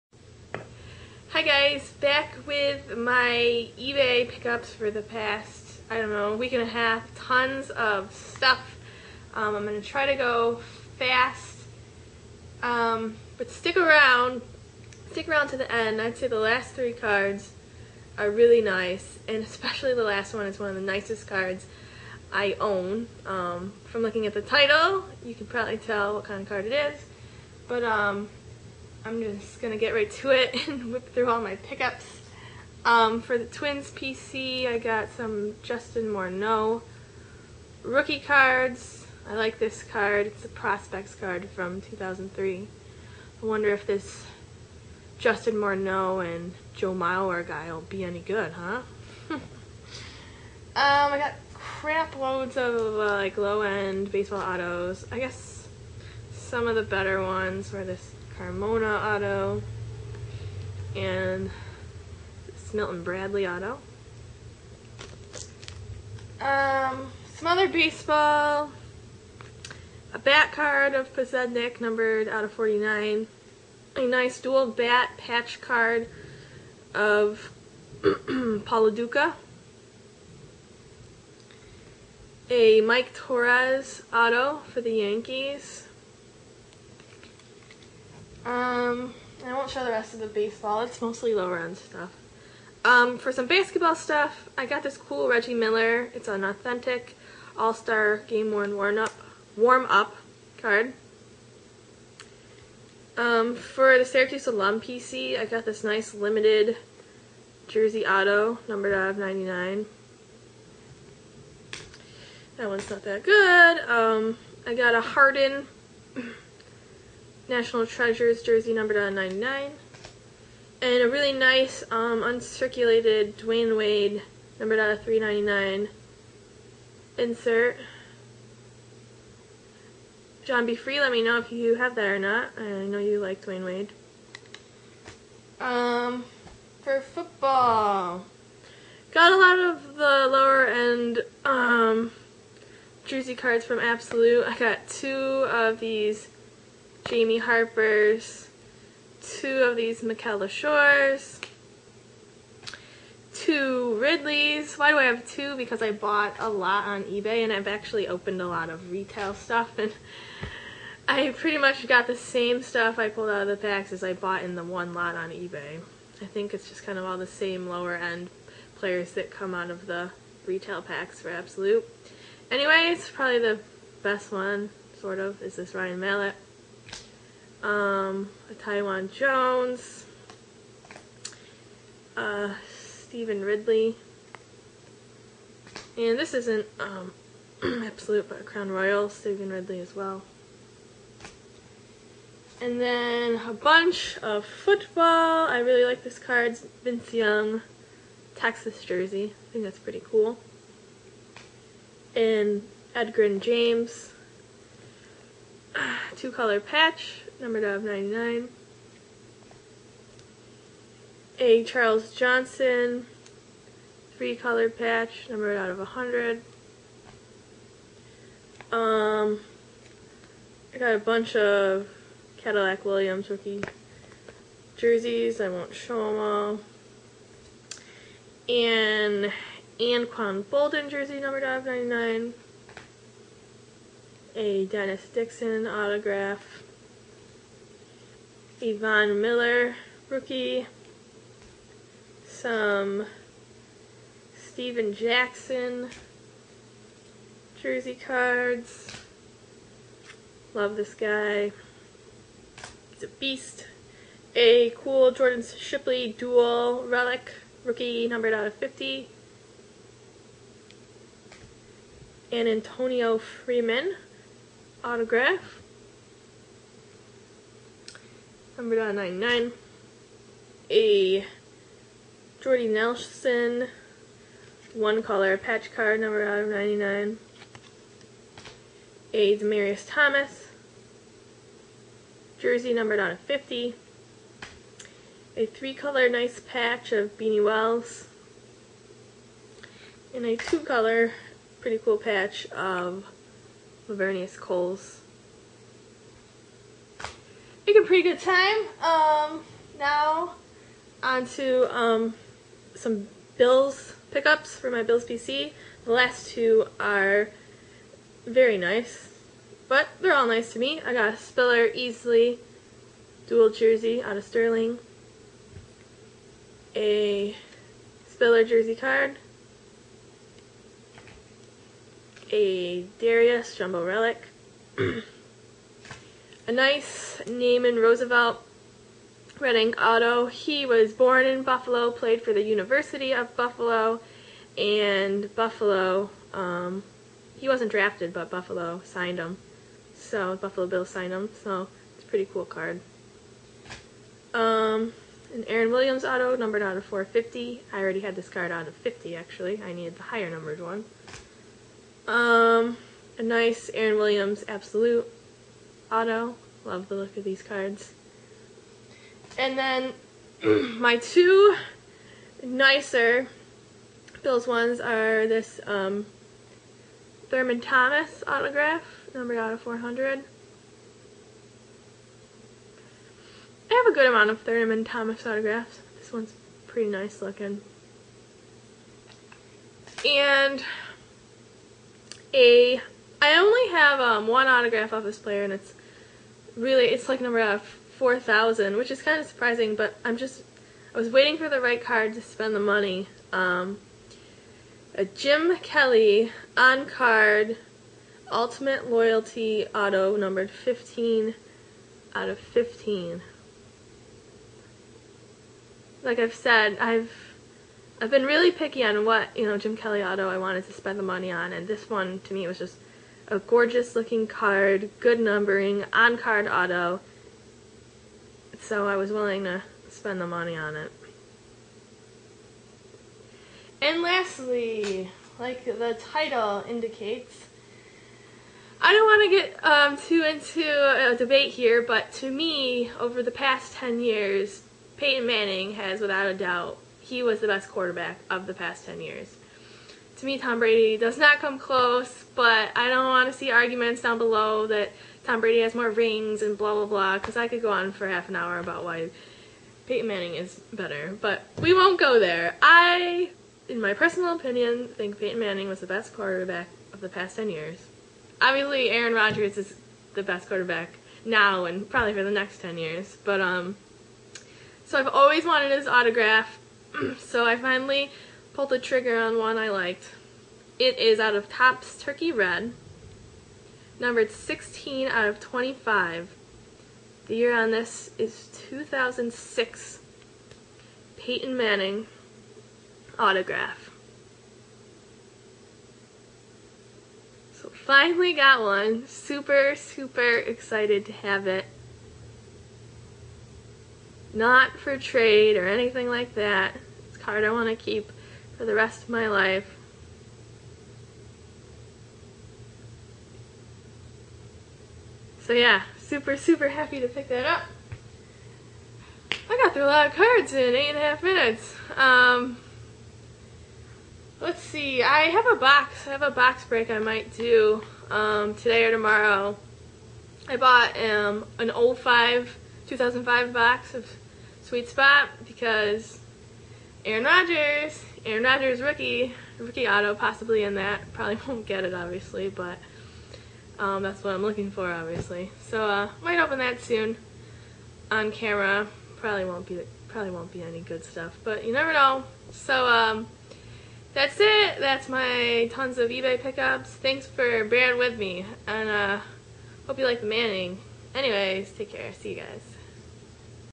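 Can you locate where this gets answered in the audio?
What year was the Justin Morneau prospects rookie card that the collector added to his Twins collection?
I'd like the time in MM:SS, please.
00:41.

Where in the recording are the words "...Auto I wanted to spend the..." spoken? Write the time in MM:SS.
06:50.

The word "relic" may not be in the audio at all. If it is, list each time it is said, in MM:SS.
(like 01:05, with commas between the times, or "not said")
04:16, 05:23.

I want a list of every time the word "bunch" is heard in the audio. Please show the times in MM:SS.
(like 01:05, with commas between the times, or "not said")
03:13, 03:40.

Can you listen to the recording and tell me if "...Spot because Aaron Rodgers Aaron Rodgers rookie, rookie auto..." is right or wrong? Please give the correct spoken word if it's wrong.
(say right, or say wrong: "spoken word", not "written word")
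right.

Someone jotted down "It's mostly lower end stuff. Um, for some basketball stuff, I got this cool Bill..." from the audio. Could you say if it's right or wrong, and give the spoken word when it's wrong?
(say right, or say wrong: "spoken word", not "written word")
wrong: "Reggie", not "Bill".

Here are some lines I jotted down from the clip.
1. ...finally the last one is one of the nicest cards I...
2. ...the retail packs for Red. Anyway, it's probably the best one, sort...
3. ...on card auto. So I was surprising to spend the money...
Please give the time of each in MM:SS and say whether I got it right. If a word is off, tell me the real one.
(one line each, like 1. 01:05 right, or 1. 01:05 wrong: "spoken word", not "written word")
1. 00:19 wrong: "especially", not "finally"
2. 02:49 wrong: "Absolute", not "Red"
3. 06:55 wrong: "willing", not "surprising".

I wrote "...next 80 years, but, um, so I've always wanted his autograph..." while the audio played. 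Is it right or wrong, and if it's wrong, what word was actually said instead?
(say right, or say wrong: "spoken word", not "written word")
wrong: "10", not "80".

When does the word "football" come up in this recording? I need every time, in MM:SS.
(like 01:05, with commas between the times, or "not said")
02:17, 03:14.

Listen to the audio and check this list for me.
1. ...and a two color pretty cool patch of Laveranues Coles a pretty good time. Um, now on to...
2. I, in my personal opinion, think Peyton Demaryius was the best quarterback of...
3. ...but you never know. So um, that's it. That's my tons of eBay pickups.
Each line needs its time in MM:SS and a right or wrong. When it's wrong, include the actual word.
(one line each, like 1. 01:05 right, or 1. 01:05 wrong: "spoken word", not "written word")
1. 04:50 right
2. 07:32 wrong: "Manning", not "Demaryius"
3. 09:01 right.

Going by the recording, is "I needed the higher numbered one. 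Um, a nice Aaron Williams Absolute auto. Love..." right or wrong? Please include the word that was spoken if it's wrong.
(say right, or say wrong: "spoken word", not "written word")
right.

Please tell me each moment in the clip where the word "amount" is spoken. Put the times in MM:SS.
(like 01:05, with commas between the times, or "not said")
06:14.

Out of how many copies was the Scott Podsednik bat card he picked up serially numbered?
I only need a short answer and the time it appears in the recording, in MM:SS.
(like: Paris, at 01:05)
49, at 01:12.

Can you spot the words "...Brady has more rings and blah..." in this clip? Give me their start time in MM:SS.
07:25.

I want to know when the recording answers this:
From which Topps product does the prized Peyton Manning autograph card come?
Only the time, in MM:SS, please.
07:52.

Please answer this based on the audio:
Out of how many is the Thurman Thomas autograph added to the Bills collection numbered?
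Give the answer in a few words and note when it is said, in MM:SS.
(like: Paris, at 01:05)
400, at 06:09.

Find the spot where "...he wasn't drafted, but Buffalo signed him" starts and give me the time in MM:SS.
05:37.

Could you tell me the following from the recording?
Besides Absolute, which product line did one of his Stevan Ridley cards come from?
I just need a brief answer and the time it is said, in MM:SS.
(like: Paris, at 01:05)
Crown Royal, at 03:08.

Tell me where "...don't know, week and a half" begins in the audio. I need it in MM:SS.
00:05.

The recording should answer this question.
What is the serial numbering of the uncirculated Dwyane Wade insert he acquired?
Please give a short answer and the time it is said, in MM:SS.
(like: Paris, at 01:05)
399, at 02:04.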